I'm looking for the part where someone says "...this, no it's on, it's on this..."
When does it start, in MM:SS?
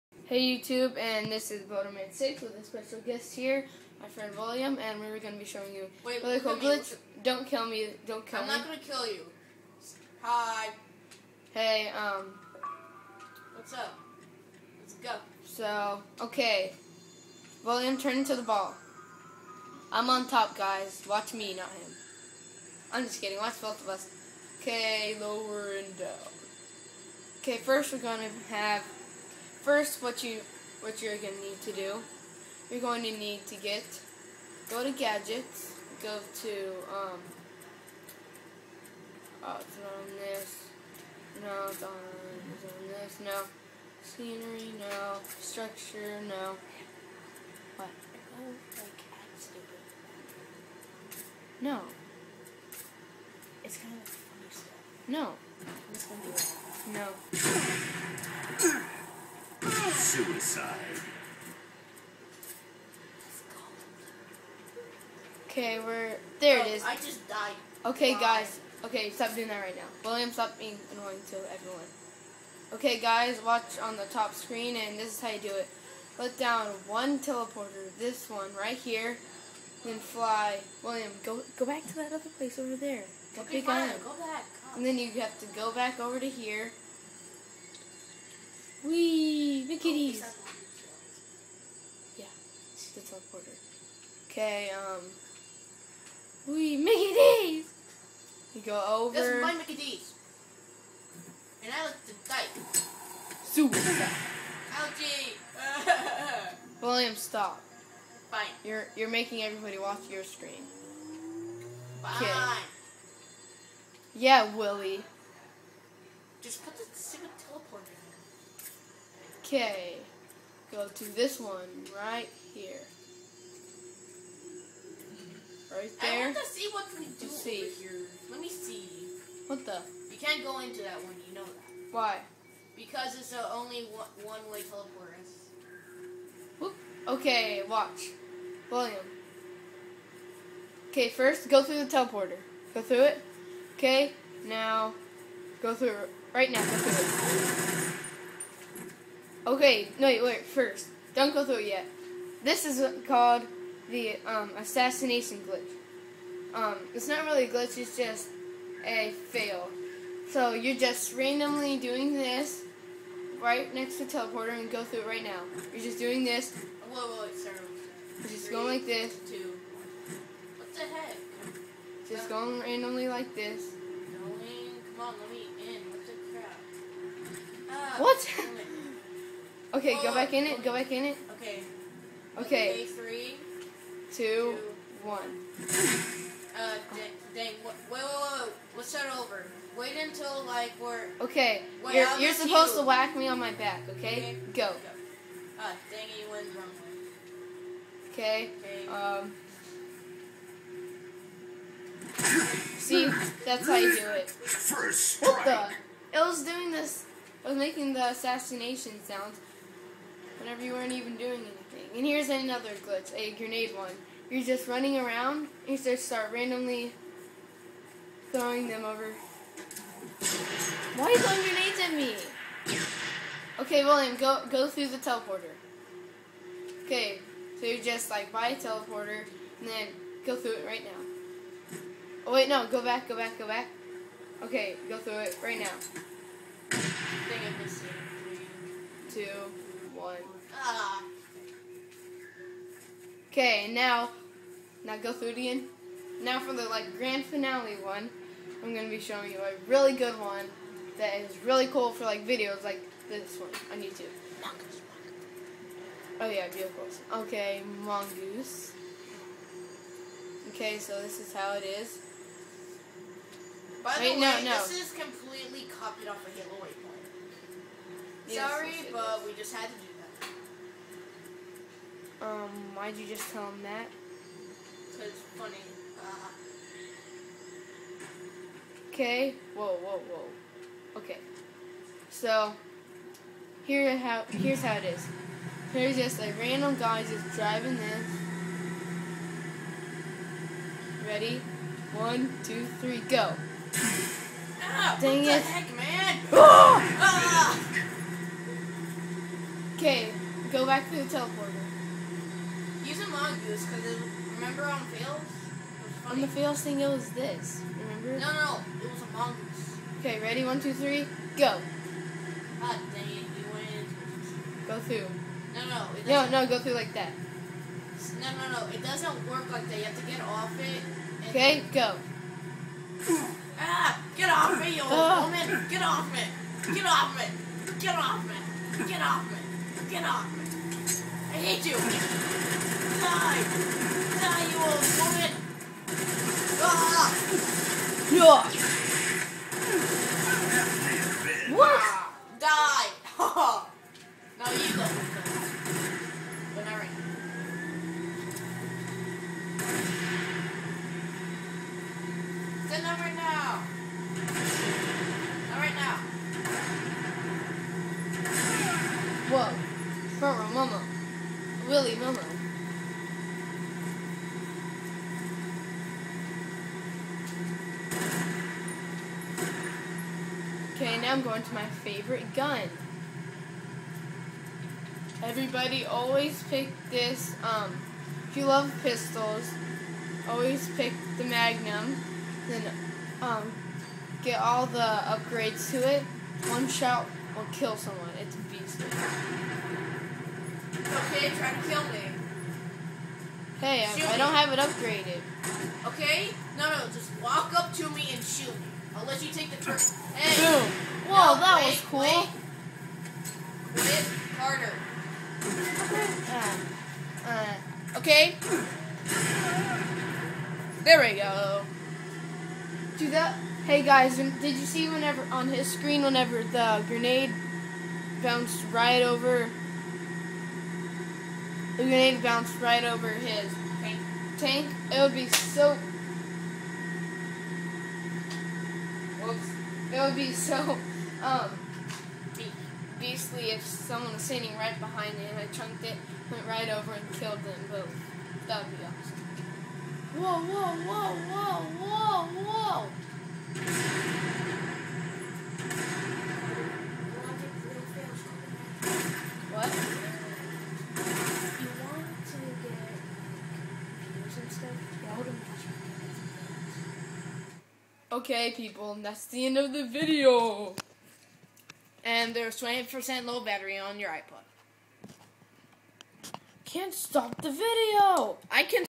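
00:40.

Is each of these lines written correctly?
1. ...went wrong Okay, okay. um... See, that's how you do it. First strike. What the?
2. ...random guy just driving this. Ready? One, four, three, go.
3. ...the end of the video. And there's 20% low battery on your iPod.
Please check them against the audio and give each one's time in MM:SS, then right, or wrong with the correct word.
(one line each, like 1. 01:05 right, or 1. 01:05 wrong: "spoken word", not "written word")
1. 03:16 right
2. 04:46 wrong: "two", not "four"
3. 07:39 right.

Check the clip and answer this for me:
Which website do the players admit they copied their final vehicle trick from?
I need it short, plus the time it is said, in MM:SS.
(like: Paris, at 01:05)
Halo Waypoint, at 04:26.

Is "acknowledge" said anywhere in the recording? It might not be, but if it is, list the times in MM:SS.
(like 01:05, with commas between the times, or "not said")
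not said.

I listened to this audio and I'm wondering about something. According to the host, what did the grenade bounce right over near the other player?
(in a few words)
his tank.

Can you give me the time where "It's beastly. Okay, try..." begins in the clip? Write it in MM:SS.
06:28.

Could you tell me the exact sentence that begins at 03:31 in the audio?
And here's another glitch, a grenade one.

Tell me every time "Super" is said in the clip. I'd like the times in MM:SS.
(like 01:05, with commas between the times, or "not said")
01:43.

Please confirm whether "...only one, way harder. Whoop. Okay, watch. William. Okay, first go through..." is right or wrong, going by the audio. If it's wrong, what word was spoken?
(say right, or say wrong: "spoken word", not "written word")
wrong: "teleporter", not "harder".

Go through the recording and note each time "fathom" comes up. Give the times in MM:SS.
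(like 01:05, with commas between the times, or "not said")
not said.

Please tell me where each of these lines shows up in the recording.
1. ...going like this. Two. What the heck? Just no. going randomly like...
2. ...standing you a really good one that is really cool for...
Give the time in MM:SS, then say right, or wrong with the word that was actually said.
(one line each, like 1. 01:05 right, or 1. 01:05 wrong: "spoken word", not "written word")
1. 02:48 right
2. 04:08 wrong: "showing", not "standing".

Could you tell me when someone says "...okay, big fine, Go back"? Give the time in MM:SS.
01:23.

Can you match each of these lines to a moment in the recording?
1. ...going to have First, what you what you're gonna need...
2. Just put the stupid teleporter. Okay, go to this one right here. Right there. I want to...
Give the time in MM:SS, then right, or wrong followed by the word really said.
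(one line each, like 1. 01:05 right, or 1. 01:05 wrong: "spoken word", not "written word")
1. 00:27 right
2. 01:56 right.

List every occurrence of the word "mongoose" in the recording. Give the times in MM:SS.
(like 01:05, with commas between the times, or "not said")
04:17, 05:03, 05:09.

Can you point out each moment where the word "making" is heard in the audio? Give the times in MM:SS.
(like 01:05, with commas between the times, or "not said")
01:49, 03:27.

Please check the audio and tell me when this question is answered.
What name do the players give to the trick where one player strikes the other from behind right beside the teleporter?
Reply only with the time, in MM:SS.
02:34.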